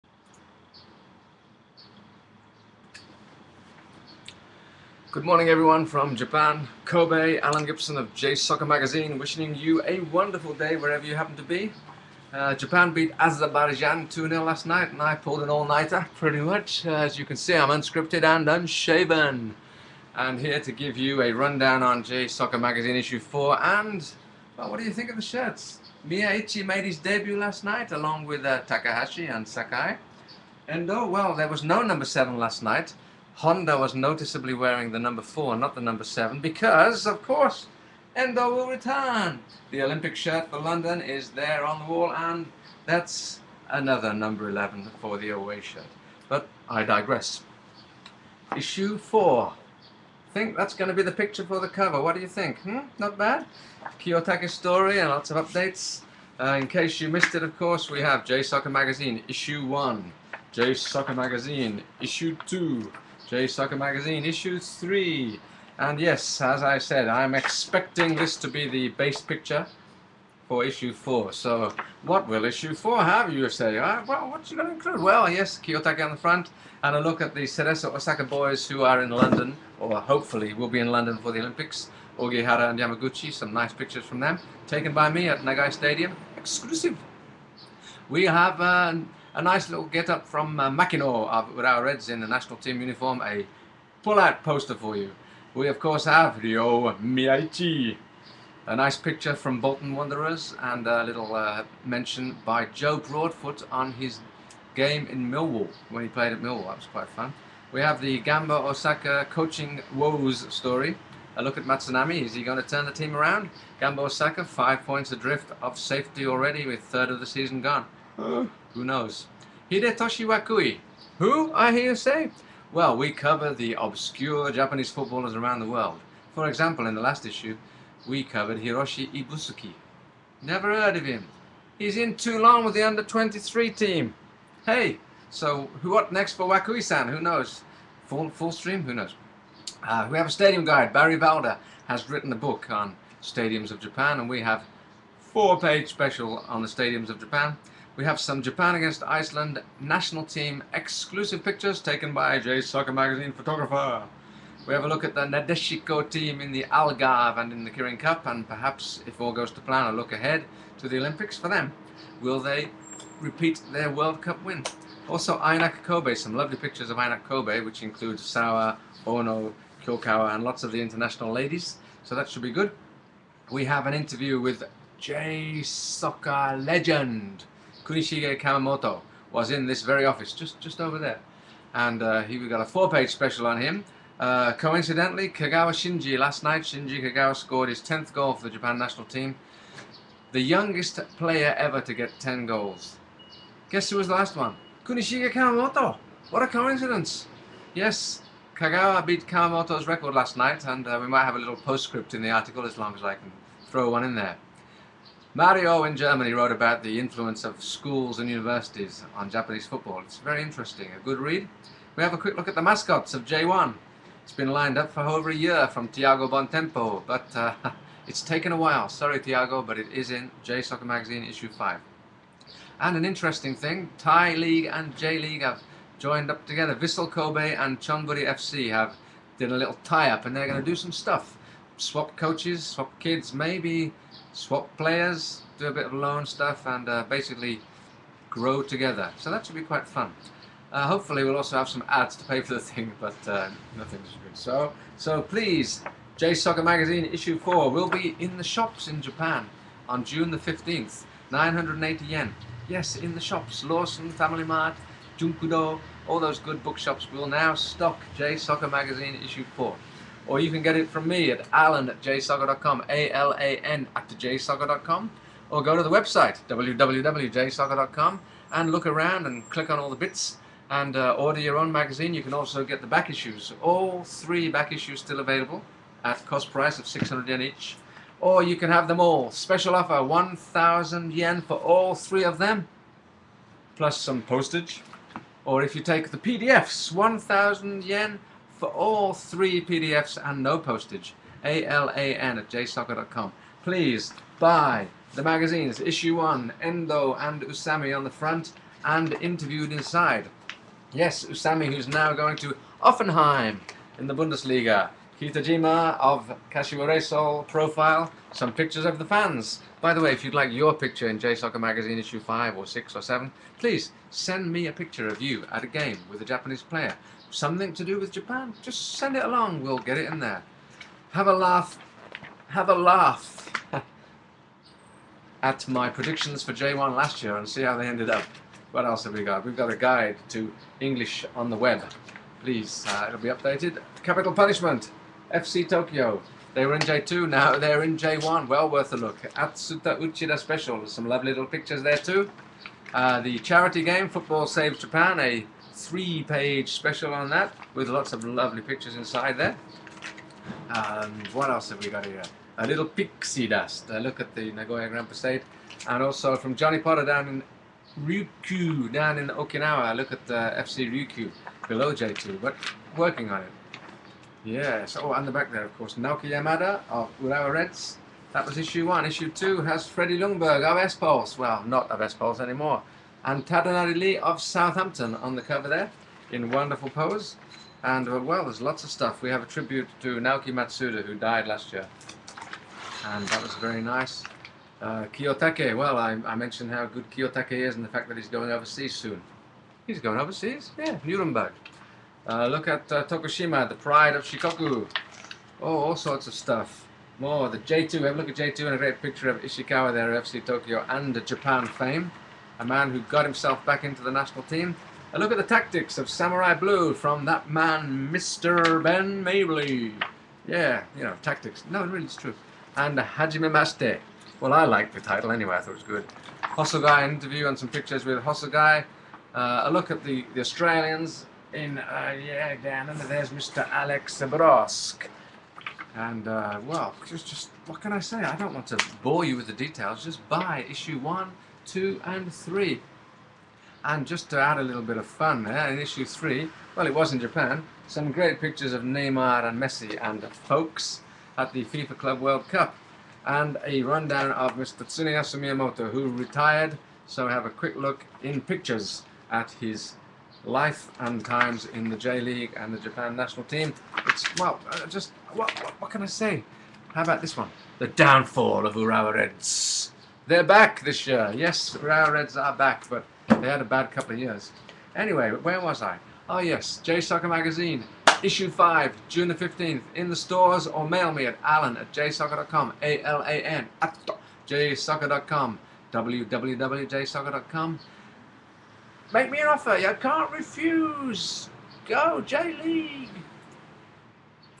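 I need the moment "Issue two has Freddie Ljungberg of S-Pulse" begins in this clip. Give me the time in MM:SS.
06:09.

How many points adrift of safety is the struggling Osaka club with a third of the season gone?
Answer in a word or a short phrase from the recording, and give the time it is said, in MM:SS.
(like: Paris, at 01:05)
5, at 01:54.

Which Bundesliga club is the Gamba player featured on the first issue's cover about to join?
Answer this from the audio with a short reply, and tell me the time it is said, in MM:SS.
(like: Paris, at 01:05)
Hoffenheim, at 05:02.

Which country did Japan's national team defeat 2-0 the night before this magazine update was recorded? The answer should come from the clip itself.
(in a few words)
Azerbaijan.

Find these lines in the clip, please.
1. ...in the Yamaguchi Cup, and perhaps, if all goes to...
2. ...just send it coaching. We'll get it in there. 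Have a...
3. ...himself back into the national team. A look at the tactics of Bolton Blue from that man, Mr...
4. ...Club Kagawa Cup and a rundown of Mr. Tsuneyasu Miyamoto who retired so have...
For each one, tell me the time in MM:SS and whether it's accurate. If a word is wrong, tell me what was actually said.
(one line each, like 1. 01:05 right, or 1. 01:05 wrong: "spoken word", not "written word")
1. 02:37 wrong: "Kirin", not "Yamaguchi"
2. 05:18 wrong: "along", not "coaching"
3. 06:43 wrong: "Samurai", not "Bolton"
4. 07:21 wrong: "World", not "Kagawa".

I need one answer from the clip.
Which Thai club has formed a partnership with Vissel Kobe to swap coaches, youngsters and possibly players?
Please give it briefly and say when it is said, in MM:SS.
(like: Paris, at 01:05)
Chonburi FC, at 03:47.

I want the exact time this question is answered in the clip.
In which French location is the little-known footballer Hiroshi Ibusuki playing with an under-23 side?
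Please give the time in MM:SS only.
02:12.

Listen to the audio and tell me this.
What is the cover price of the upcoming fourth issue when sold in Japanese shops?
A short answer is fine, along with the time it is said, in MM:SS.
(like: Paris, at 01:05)
980 yen, at 04:11.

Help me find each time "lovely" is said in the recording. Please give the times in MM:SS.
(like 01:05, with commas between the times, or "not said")
02:46, 05:41, 05:48.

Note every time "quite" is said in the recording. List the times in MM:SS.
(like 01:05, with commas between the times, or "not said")
01:46, 03:59.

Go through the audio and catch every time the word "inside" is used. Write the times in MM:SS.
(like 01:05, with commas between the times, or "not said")
04:59, 05:48.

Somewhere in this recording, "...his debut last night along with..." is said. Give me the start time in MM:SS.
00:26.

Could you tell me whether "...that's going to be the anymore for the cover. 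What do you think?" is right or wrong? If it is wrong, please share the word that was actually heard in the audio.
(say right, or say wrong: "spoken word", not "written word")
wrong: "picture", not "anymore".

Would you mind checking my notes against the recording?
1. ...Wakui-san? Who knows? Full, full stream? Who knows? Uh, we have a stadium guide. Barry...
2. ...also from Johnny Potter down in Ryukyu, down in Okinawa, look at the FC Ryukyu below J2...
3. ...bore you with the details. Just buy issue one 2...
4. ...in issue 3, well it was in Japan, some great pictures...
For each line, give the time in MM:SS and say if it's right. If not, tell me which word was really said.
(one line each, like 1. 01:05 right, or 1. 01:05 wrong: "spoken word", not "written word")
1. 02:16 right
2. 05:56 right
3. 07:09 right
4. 07:15 right.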